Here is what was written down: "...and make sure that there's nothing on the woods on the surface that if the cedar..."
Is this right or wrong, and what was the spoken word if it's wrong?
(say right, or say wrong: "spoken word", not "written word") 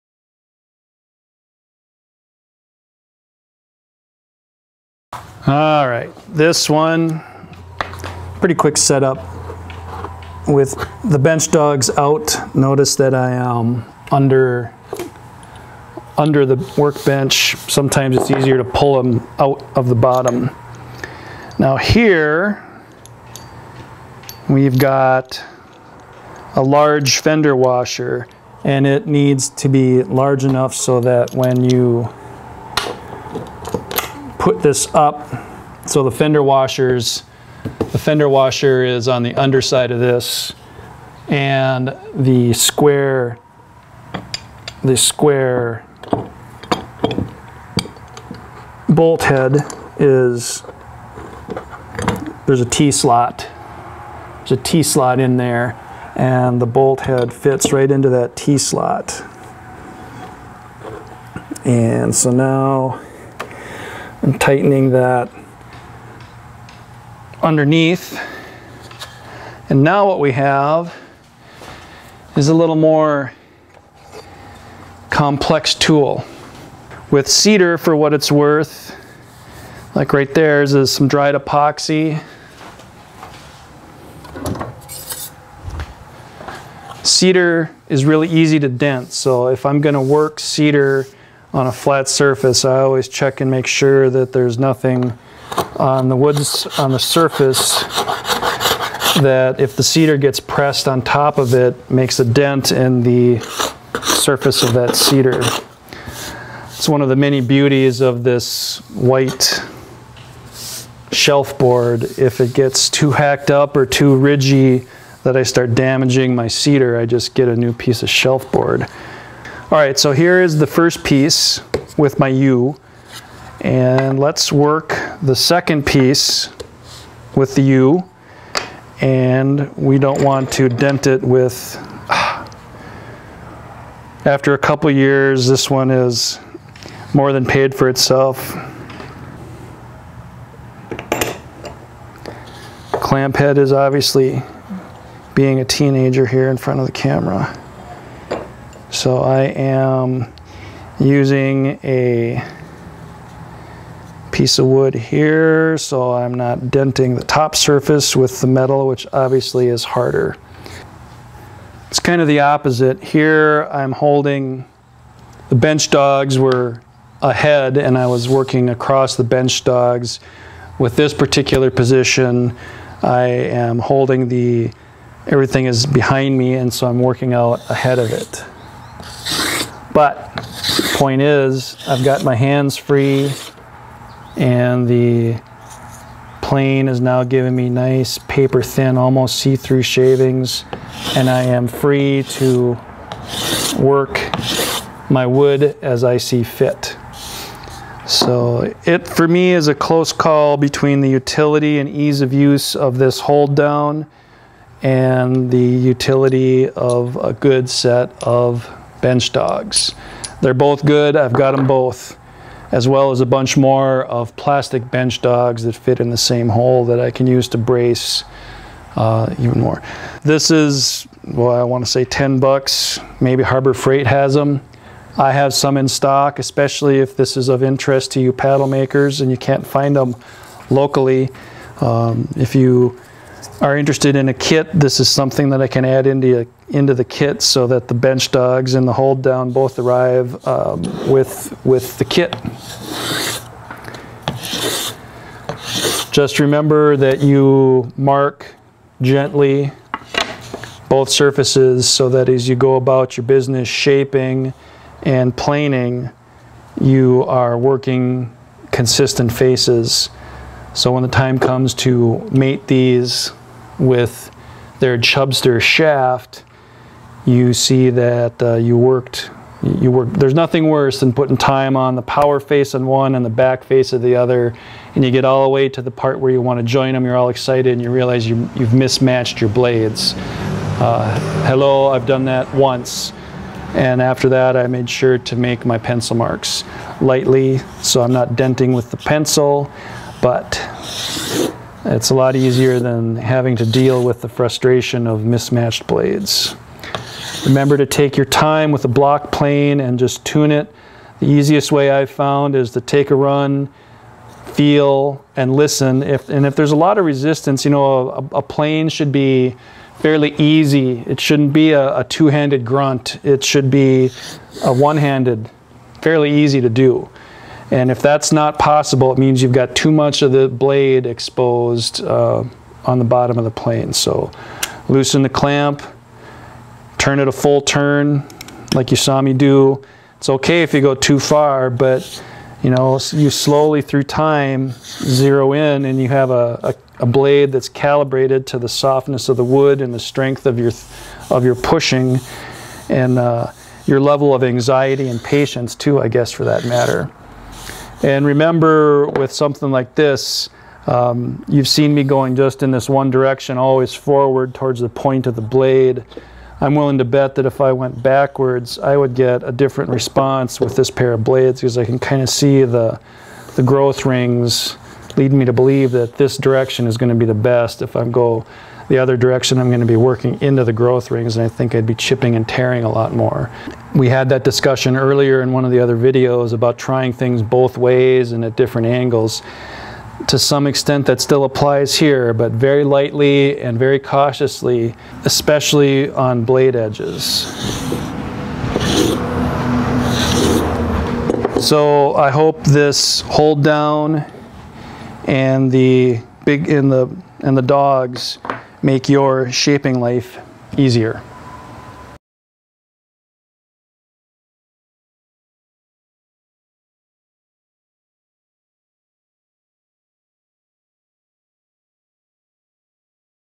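right.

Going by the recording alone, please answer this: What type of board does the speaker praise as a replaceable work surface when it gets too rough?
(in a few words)
White shelf board.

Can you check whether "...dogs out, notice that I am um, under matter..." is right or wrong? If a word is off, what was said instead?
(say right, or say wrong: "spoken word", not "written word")
wrong: "under", not "matter".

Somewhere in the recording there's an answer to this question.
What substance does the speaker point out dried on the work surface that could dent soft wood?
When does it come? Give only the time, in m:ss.
1:21.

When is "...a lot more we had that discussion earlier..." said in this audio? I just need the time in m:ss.
6:12.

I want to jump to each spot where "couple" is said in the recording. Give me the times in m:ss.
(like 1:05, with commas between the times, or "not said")
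2:14.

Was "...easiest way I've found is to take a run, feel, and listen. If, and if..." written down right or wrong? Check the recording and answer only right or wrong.
right.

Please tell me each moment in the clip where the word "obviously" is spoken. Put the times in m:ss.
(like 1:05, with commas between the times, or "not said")
2:23, 2:39.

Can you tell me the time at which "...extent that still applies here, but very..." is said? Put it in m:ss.
6:20.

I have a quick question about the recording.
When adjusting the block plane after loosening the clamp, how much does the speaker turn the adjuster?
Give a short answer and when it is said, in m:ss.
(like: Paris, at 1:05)
A full turn, at 5:27.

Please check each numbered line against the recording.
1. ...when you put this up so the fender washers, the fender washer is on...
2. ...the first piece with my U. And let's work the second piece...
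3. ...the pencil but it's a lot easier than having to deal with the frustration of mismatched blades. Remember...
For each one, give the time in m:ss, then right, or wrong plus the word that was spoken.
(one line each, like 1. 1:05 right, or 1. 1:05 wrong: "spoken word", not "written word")
1. 0:31 right
2. 2:00 right
3. 4:48 right.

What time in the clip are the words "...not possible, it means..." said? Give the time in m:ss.
5:18.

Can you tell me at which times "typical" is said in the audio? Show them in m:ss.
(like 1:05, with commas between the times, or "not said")
not said.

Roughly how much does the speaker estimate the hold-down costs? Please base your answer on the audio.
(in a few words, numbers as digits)
$10.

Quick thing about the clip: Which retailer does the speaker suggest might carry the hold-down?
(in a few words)
Harbor Freight.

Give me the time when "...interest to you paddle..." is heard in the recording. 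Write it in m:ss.
3:47.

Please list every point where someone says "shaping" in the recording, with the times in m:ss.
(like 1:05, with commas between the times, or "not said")
4:13, 6:39.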